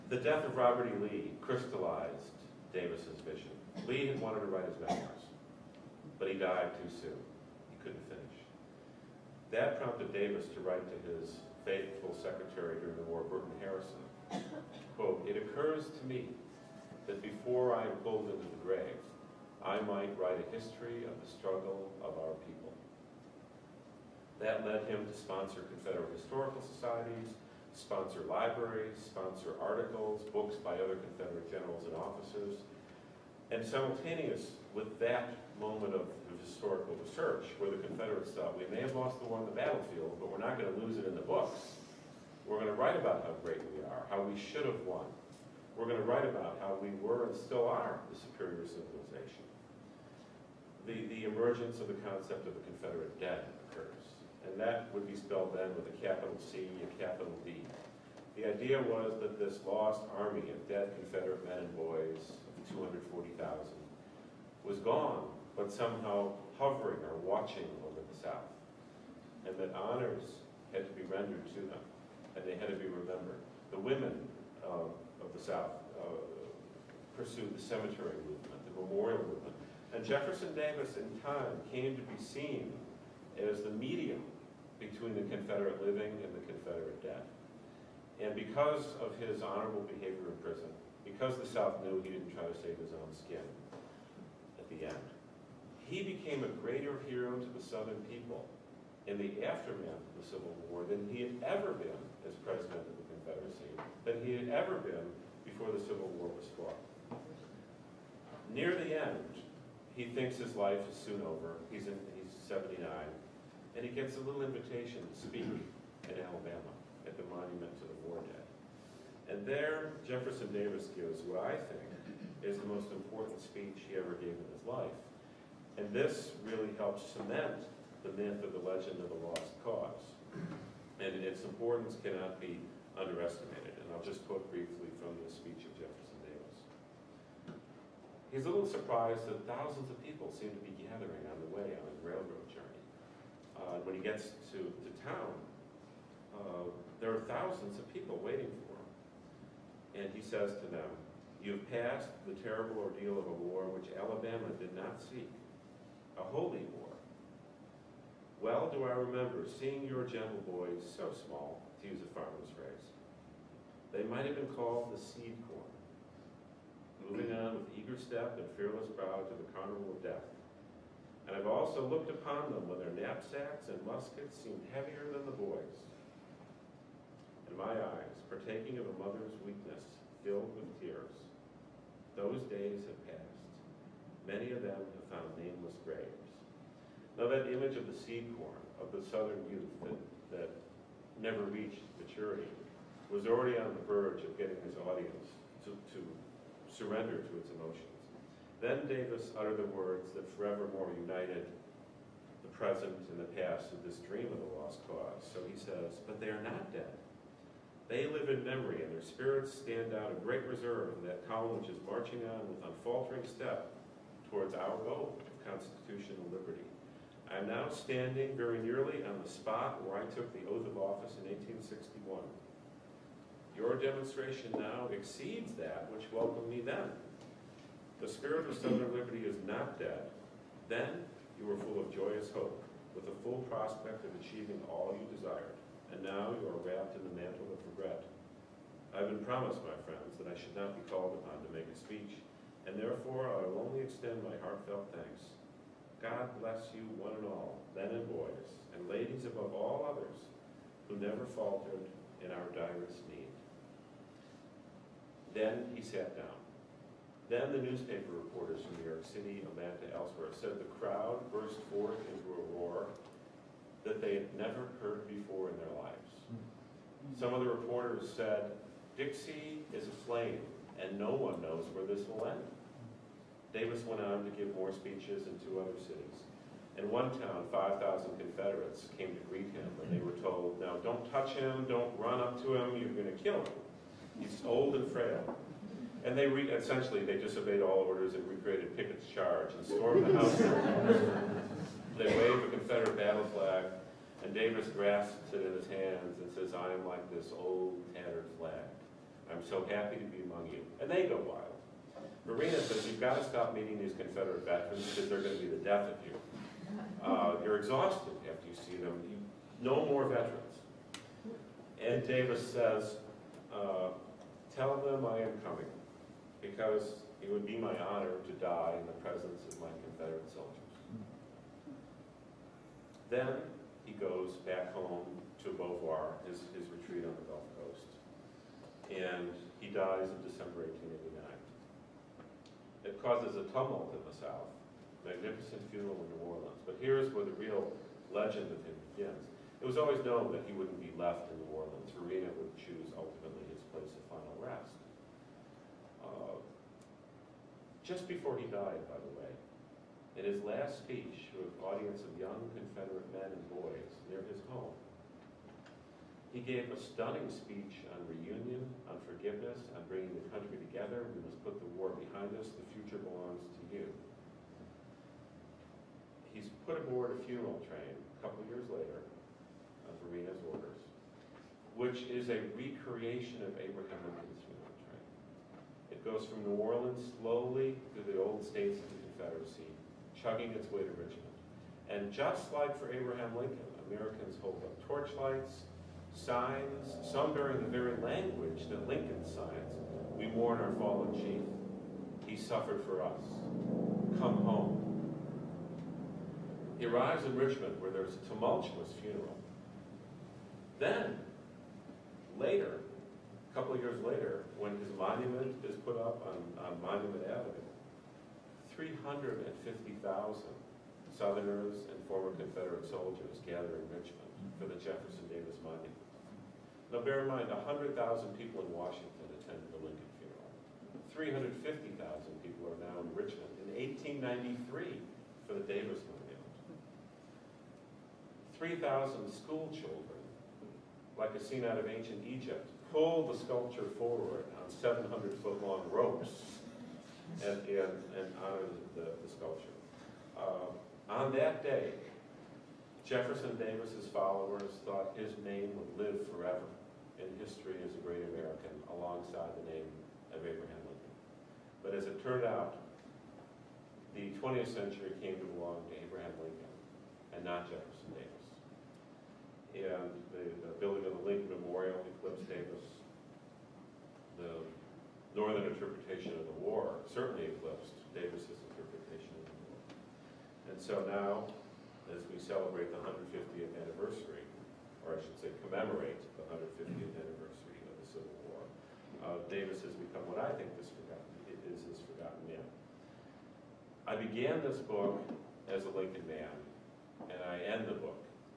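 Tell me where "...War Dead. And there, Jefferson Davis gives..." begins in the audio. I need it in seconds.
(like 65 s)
118 s.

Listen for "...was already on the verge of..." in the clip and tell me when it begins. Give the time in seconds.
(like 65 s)
193 s.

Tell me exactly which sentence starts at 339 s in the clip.
It was always known that he wouldn't be left in New Orleans.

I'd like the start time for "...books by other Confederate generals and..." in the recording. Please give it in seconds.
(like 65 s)
30 s.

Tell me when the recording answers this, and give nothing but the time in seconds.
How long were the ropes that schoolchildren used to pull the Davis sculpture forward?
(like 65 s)
434 s.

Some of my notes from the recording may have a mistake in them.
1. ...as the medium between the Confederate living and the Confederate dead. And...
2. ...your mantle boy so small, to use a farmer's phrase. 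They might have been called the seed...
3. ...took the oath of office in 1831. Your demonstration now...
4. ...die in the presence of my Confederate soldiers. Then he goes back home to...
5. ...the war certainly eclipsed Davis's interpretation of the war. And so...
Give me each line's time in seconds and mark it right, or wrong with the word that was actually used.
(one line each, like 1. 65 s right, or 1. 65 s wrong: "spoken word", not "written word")
1. 83 s right
2. 159 s wrong: "gentle", not "mantle"
3. 220 s wrong: "1861", not "1831"
4. 318 s right
5. 466 s right.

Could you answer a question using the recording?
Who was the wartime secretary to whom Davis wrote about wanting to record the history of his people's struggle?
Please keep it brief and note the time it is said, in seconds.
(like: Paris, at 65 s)
Burton Harrison, at 13 s.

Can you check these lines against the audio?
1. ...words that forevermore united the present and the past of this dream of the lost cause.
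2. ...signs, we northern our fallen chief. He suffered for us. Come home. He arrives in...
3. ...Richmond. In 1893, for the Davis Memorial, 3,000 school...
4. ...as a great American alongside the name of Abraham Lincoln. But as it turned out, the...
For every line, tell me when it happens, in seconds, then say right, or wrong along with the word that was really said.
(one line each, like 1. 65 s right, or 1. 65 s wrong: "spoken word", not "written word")
1. 199 s right
2. 389 s wrong: "mourn", not "northern"
3. 423 s right
4. 447 s right.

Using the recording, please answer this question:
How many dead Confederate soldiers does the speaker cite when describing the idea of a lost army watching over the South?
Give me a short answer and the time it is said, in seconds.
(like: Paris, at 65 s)
240,000, at 62 s.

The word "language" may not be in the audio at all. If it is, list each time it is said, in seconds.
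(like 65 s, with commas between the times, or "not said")
387 s.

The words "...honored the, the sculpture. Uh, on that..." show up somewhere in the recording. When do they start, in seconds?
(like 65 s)
438 s.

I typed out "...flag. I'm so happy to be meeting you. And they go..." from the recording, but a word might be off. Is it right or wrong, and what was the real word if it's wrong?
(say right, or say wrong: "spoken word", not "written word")
wrong: "among", not "meeting".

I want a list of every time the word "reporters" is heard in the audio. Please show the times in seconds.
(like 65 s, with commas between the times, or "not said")
258 s, 267 s.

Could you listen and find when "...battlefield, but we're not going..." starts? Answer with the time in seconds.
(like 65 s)
39 s.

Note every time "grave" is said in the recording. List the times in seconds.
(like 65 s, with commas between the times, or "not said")
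18 s, 185 s.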